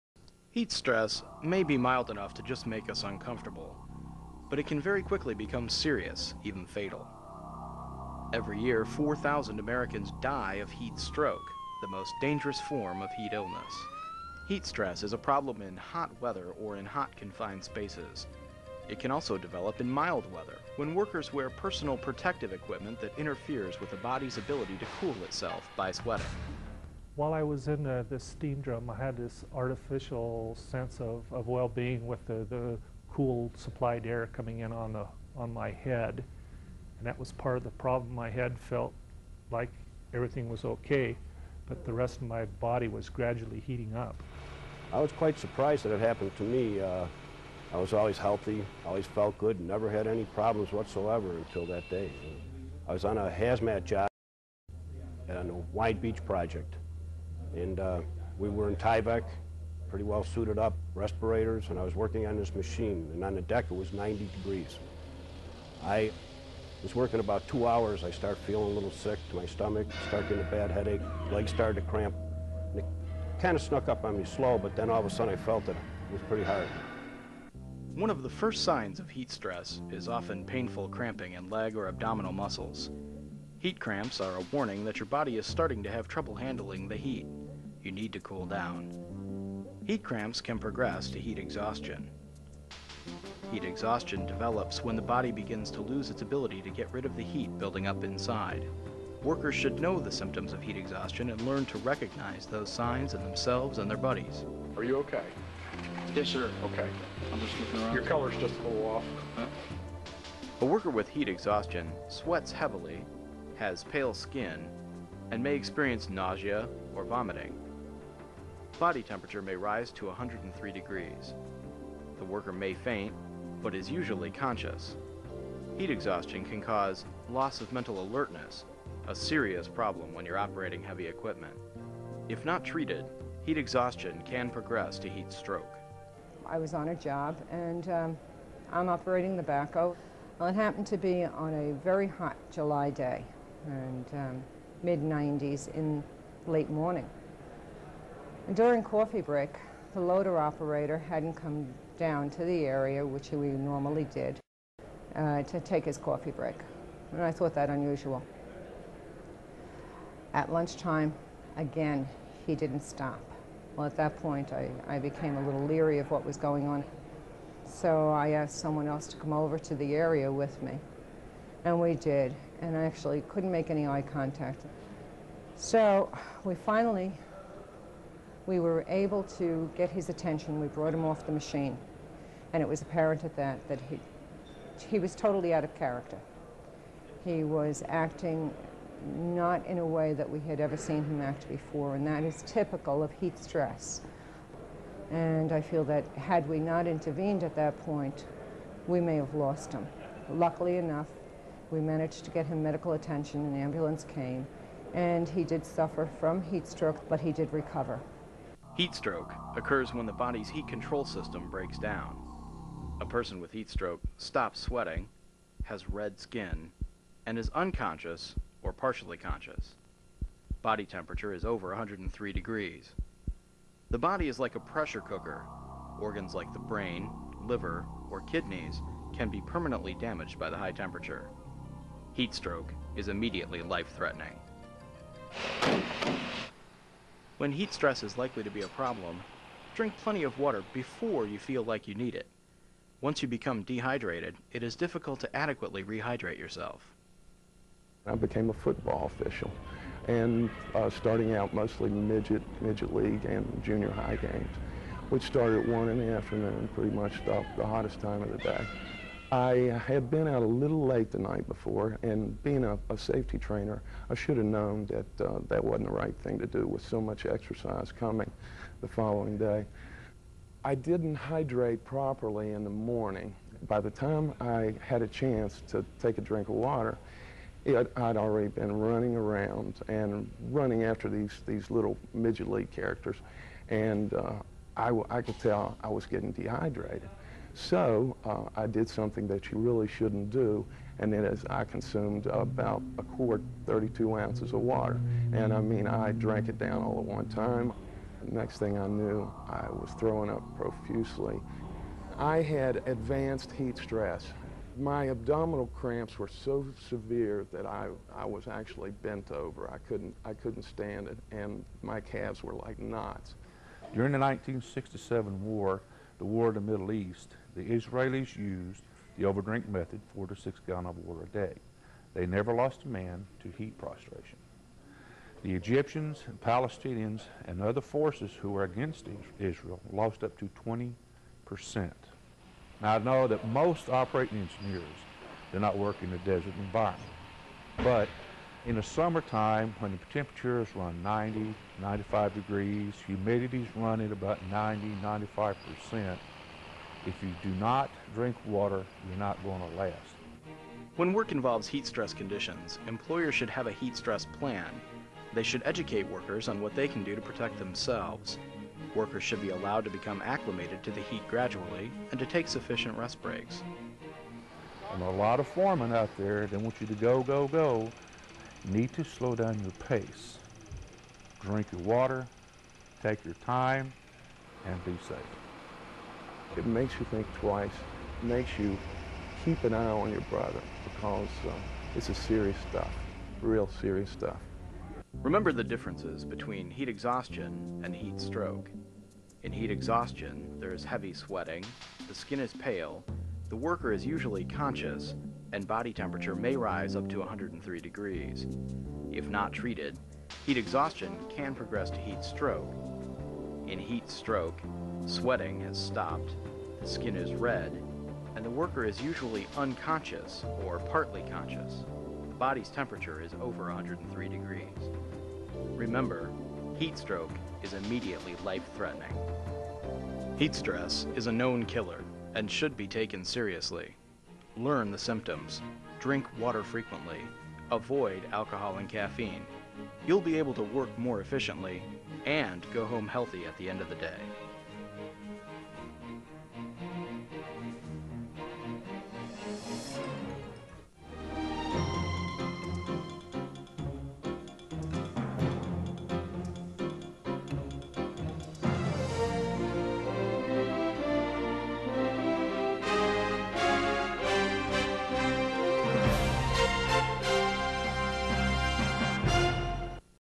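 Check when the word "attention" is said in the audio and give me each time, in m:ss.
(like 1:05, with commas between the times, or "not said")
3:00, 3:22.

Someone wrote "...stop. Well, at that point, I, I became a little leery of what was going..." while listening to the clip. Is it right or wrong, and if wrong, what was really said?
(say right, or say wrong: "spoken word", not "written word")
right.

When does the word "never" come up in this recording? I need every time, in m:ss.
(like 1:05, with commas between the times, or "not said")
0:49, 5:22.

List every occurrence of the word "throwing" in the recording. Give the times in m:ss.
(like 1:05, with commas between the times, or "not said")
4:59.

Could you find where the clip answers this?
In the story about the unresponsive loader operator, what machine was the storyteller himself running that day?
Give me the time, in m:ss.
2:19.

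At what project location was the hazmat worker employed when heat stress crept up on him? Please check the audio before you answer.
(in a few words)
White Beach.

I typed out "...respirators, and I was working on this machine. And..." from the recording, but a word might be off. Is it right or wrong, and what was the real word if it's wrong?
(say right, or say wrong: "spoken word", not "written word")
right.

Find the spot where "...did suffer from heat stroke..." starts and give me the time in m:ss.
3:25.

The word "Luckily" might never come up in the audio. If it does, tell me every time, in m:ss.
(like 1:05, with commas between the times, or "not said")
3:20.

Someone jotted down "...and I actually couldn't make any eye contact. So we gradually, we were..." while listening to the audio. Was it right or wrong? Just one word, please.
wrong.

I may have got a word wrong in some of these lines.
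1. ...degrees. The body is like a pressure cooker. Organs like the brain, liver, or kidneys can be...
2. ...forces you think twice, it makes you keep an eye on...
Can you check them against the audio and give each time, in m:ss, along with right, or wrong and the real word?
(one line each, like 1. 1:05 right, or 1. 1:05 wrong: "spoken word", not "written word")
1. 3:42 right
2. 6:16 wrong: "makes", not "forces".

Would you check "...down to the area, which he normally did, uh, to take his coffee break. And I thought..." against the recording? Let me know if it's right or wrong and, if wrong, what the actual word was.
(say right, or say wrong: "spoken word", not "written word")
right.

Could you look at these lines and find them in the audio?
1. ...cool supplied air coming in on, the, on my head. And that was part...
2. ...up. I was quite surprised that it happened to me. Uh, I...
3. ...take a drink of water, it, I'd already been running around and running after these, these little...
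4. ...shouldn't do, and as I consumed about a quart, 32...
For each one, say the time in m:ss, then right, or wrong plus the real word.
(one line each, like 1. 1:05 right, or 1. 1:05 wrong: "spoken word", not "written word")
1. 0:33 right
2. 0:43 right
3. 4:36 right
4. 4:49 right.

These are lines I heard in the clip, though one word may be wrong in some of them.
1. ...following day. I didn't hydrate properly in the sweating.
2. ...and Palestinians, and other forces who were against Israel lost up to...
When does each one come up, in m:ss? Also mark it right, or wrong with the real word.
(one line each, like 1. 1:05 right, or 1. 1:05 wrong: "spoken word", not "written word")
1. 4:28 wrong: "morning", not "sweating"
2. 5:26 right.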